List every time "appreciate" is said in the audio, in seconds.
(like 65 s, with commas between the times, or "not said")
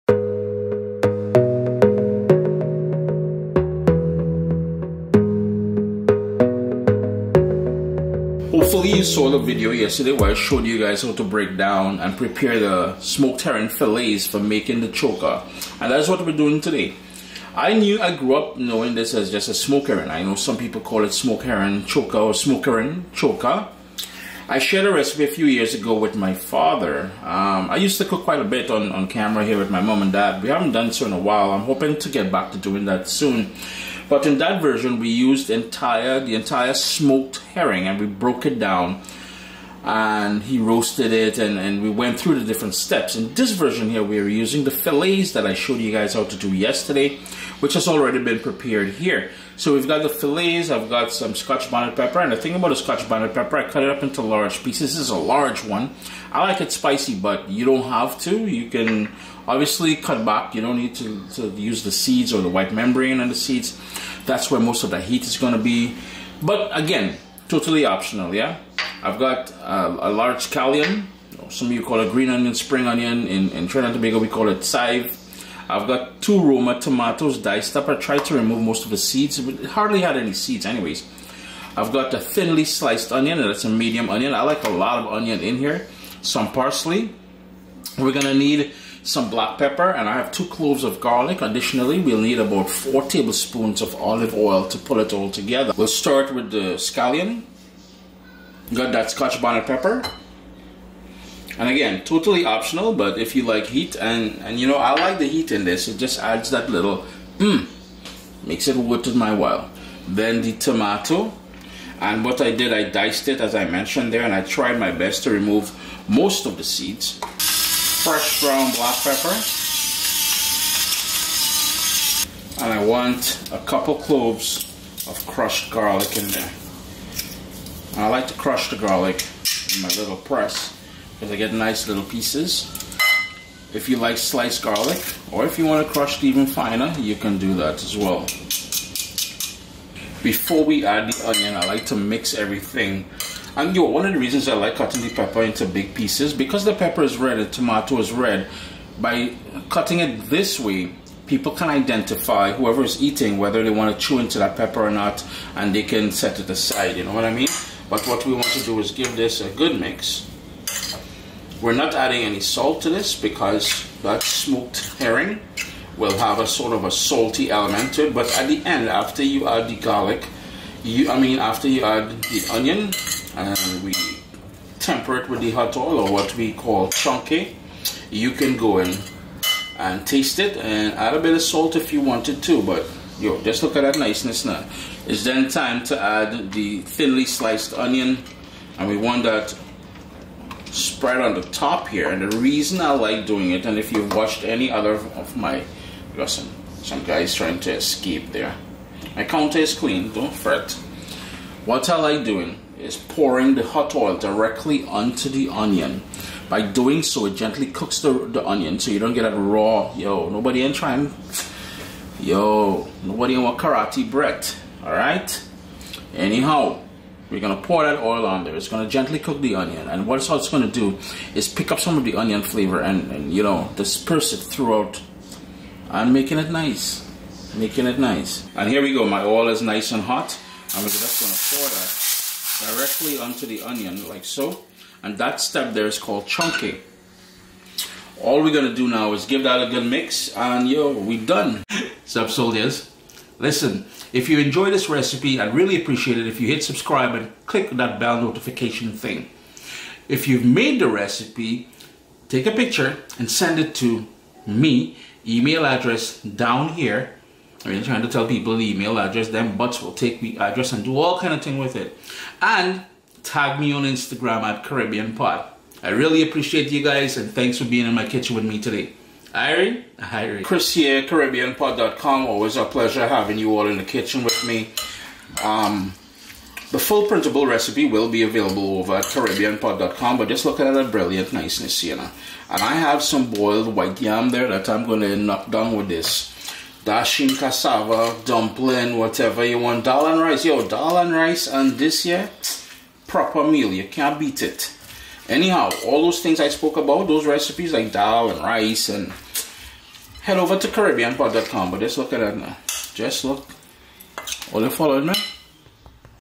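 245 s, 266 s.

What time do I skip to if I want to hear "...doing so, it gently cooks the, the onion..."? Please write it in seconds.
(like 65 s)
206 s.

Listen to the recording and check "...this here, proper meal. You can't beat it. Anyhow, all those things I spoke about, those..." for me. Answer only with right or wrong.
right.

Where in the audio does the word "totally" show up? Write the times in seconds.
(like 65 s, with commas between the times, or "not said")
67 s, 102 s.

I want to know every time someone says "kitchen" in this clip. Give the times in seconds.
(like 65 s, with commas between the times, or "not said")
268 s, 273 s.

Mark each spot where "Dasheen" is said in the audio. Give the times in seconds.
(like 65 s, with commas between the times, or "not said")
286 s.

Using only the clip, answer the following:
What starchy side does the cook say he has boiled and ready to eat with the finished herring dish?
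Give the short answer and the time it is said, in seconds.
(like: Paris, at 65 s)
white yam, at 283 s.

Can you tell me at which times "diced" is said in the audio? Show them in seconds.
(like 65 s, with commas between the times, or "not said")
77 s, 112 s.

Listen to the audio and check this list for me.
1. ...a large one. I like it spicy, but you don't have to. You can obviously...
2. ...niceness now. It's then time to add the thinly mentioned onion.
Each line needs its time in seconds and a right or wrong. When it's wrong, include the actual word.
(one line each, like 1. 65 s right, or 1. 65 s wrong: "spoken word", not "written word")
1. 55 s right
2. 183 s wrong: "sliced", not "mentioned".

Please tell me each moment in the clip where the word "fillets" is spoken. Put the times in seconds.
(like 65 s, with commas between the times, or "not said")
13 s, 44 s, 50 s.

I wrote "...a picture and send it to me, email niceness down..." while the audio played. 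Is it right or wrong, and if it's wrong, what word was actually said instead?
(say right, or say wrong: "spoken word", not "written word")
wrong: "address", not "niceness".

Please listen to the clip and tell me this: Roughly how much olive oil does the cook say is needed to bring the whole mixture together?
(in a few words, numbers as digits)
4 tablespoons.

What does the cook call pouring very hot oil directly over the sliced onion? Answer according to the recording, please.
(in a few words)
chunkay.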